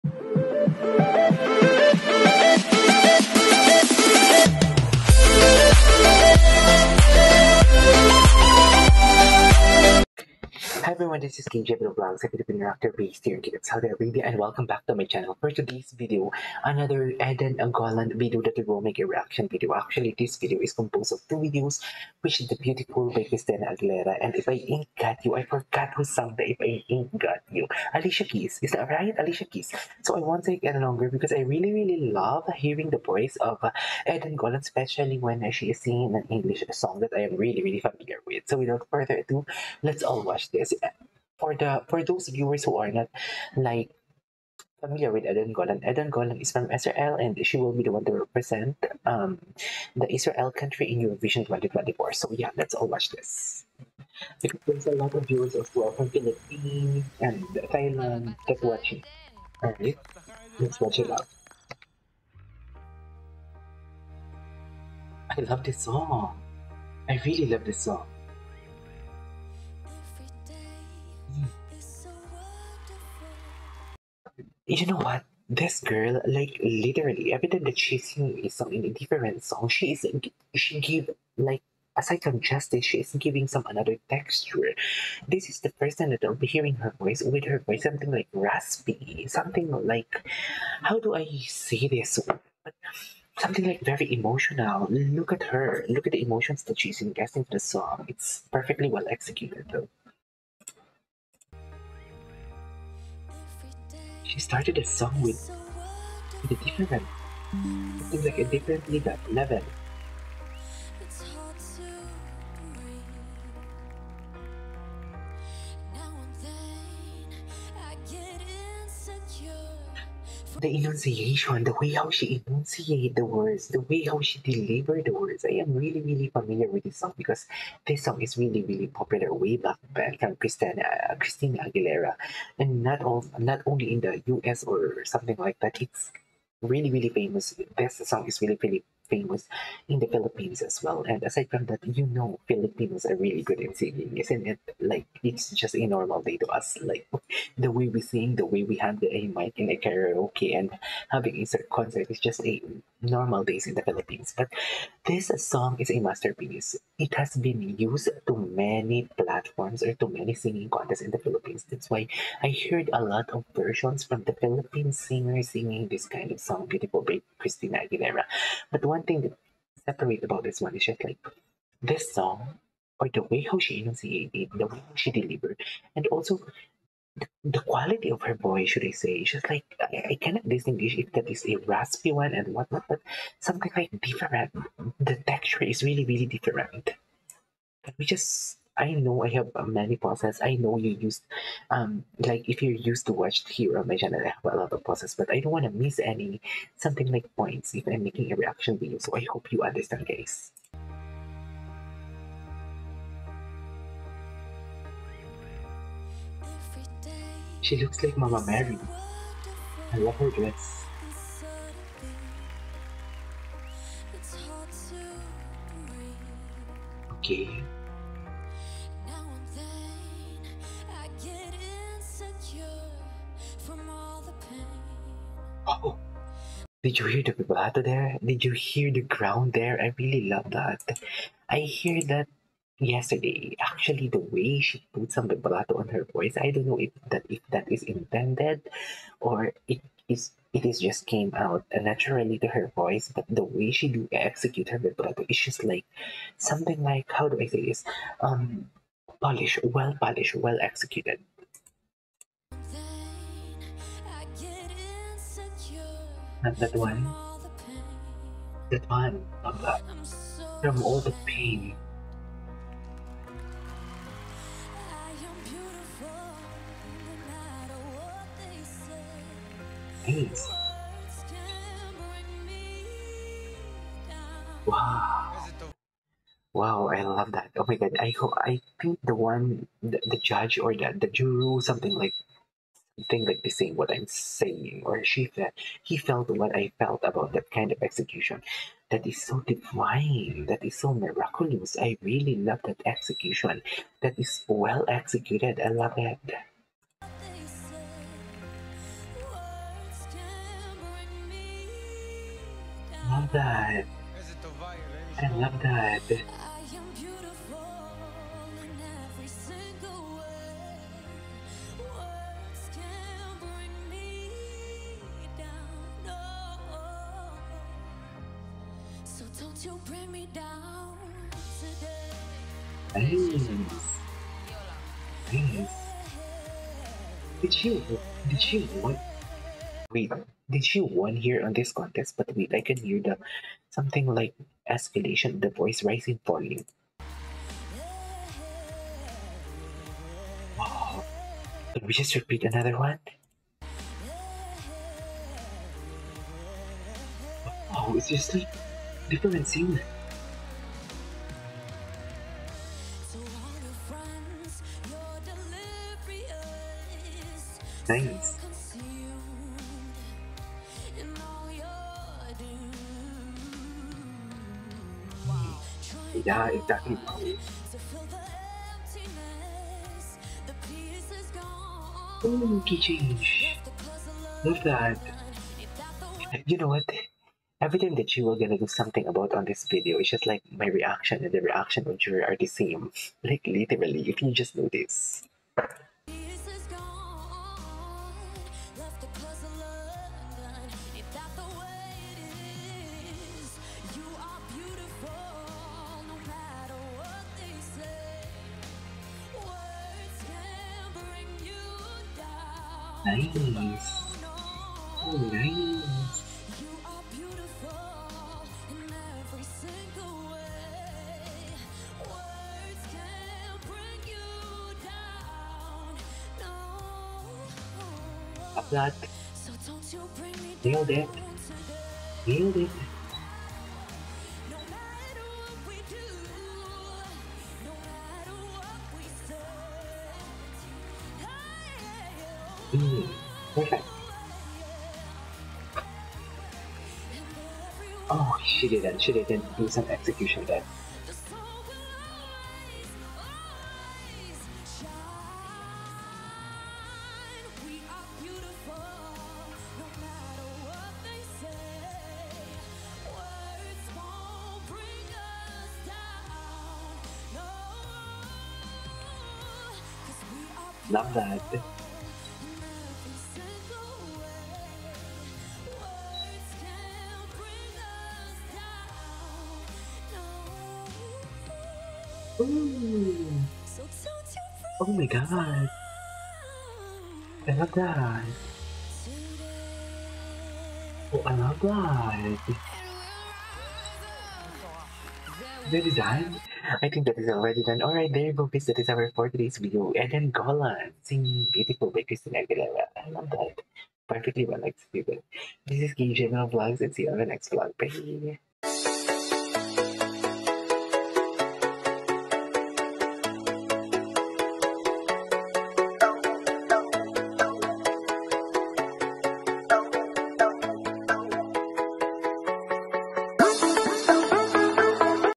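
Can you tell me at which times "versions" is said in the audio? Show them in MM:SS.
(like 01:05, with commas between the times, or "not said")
02:43.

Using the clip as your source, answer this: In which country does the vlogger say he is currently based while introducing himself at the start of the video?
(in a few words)
Saudi Arabia.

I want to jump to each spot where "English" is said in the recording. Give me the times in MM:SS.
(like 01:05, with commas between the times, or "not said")
00:36.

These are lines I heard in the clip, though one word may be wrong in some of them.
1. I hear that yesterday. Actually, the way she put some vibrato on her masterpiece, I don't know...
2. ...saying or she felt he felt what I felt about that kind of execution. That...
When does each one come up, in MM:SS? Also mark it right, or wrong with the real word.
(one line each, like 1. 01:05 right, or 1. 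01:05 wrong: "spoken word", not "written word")
1. 03:51 wrong: "voice", not "masterpiece"
2. 04:44 right.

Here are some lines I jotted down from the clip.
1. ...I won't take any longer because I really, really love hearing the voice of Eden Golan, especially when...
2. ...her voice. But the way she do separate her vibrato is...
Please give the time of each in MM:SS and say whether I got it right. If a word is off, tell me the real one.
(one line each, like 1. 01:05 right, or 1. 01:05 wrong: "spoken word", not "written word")
1. 00:30 right
2. 04:02 wrong: "execute", not "separate".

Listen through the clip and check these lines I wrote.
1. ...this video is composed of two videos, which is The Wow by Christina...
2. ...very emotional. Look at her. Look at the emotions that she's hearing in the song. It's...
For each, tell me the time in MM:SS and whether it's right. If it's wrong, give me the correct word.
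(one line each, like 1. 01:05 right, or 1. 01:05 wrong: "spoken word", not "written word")
1. 00:20 wrong: "Beautiful", not "Wow"
2. 01:33 wrong: "investing", not "hearing".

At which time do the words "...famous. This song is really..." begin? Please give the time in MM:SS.
02:17.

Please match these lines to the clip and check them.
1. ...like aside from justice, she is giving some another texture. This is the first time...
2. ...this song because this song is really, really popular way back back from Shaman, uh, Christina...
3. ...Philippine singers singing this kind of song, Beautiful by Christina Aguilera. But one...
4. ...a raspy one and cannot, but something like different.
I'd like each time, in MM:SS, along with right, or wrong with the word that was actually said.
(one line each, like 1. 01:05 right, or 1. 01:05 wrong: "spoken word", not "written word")
1. 01:21 right
2. 02:06 wrong: "Christina", not "Shaman"
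3. 02:44 right
4. 03:01 wrong: "whatnot", not "cannot".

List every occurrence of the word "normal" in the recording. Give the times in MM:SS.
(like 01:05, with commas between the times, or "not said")
02:25, 02:33.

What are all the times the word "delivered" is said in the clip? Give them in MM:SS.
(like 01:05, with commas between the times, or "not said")
02:04, 02:55.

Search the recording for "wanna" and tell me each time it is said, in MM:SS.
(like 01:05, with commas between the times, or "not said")
03:15.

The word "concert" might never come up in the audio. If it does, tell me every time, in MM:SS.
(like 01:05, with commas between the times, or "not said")
02:31.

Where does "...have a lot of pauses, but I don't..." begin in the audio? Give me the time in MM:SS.
03:14.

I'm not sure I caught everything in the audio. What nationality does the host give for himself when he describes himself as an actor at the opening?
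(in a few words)
Filipino.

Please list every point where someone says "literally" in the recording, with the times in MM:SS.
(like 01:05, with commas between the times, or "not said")
01:16, 06:23.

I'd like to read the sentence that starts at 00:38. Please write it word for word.
So without further ado, let's all watch this for the for those viewers who are not like familiar with Eden Golan.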